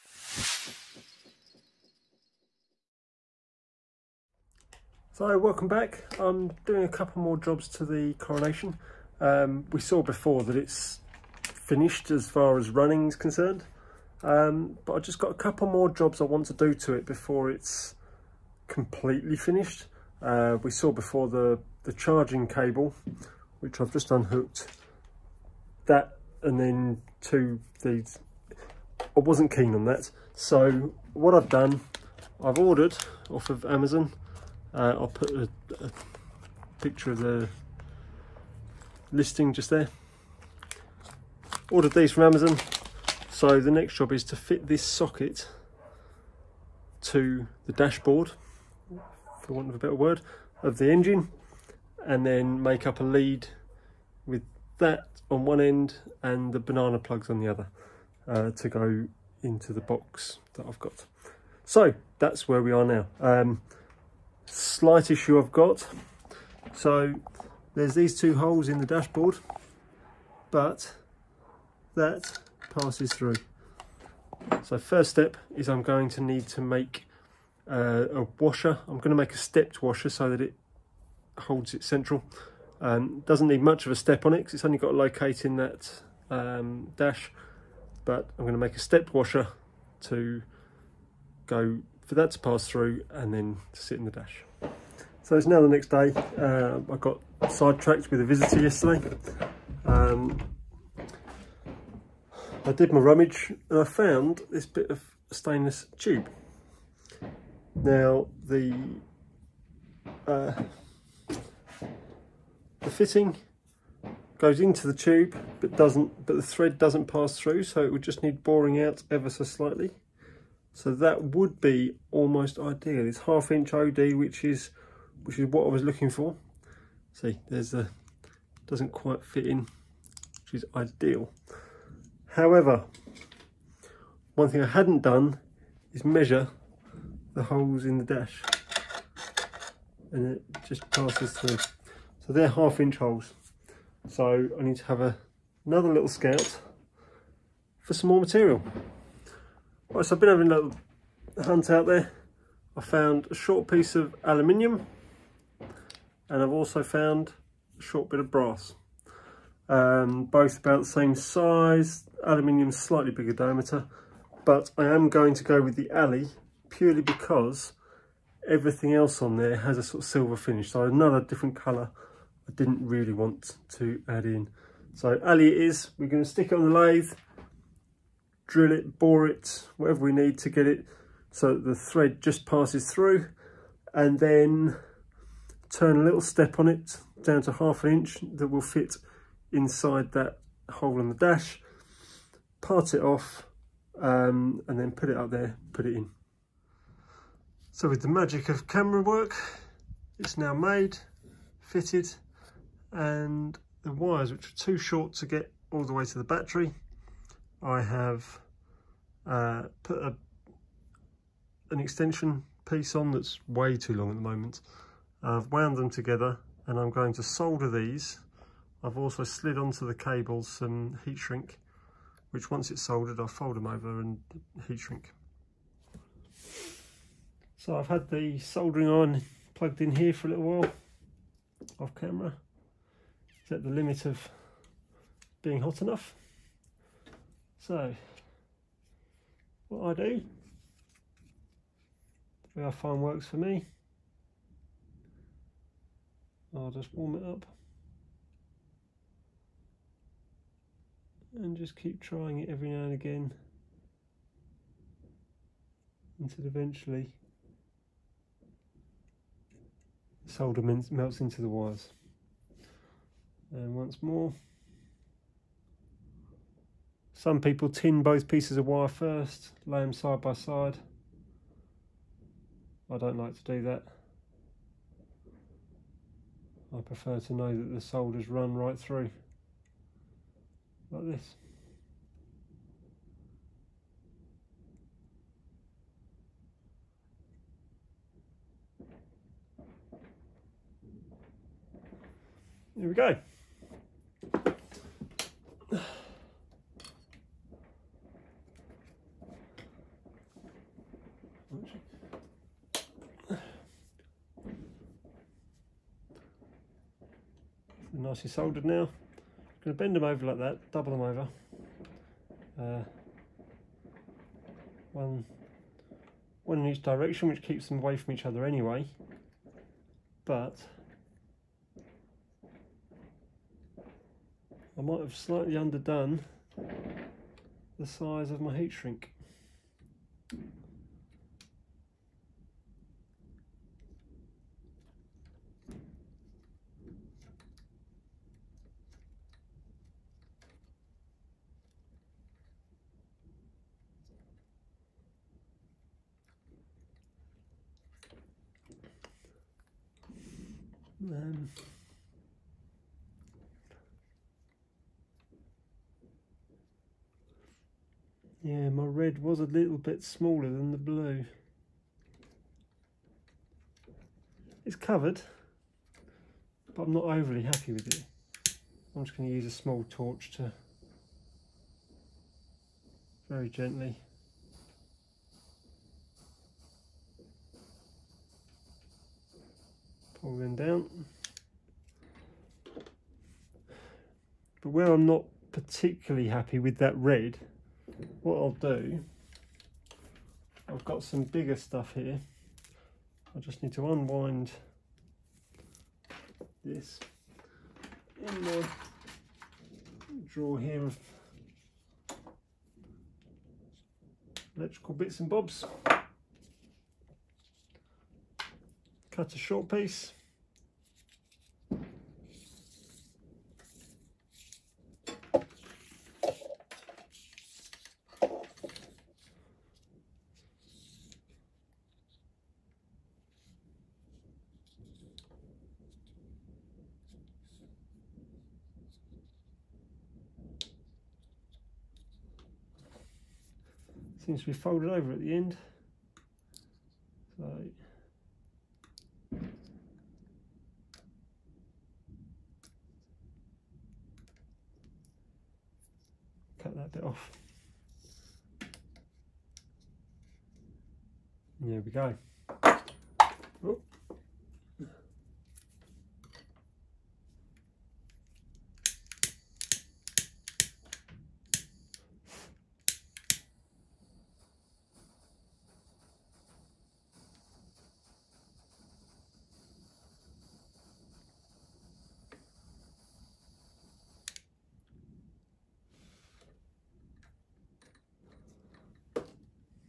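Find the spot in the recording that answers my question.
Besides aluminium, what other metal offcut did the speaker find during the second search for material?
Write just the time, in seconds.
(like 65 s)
158 s.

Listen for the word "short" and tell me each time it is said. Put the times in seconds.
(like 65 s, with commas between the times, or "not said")
153 s, 157 s, 204 s, 409 s.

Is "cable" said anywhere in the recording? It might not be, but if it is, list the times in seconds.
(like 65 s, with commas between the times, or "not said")
22 s, 219 s.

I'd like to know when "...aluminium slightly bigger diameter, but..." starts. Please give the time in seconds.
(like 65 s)
162 s.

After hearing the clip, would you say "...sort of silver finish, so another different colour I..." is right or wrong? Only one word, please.
right.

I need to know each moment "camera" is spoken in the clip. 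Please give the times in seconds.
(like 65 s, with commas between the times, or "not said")
198 s, 231 s.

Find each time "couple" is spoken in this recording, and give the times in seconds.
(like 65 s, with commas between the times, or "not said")
6 s, 15 s.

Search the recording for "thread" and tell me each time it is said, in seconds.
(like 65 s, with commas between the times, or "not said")
116 s, 181 s.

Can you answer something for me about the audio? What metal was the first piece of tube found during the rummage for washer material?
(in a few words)
stainless.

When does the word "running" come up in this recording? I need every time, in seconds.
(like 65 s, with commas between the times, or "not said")
12 s.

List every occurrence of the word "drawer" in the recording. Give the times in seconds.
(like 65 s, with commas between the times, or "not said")
400 s.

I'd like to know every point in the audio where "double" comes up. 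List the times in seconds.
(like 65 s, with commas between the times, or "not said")
310 s.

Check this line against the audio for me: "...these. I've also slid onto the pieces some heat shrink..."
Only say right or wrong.
wrong.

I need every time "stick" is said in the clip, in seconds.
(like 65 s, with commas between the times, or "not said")
176 s.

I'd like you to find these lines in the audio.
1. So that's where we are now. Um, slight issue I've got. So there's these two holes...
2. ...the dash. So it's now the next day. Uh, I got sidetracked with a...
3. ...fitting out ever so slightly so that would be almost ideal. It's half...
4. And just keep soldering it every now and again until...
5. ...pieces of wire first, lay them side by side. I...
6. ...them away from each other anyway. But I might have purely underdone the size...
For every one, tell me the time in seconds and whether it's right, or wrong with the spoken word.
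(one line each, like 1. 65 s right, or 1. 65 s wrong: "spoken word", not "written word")
1. 61 s right
2. 94 s right
3. 118 s wrong: "boring", not "fitting"
4. 251 s wrong: "trying", not "soldering"
5. 268 s right
6. 317 s wrong: "slightly", not "purely".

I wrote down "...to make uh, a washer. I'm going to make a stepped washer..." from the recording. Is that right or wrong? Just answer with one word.
right.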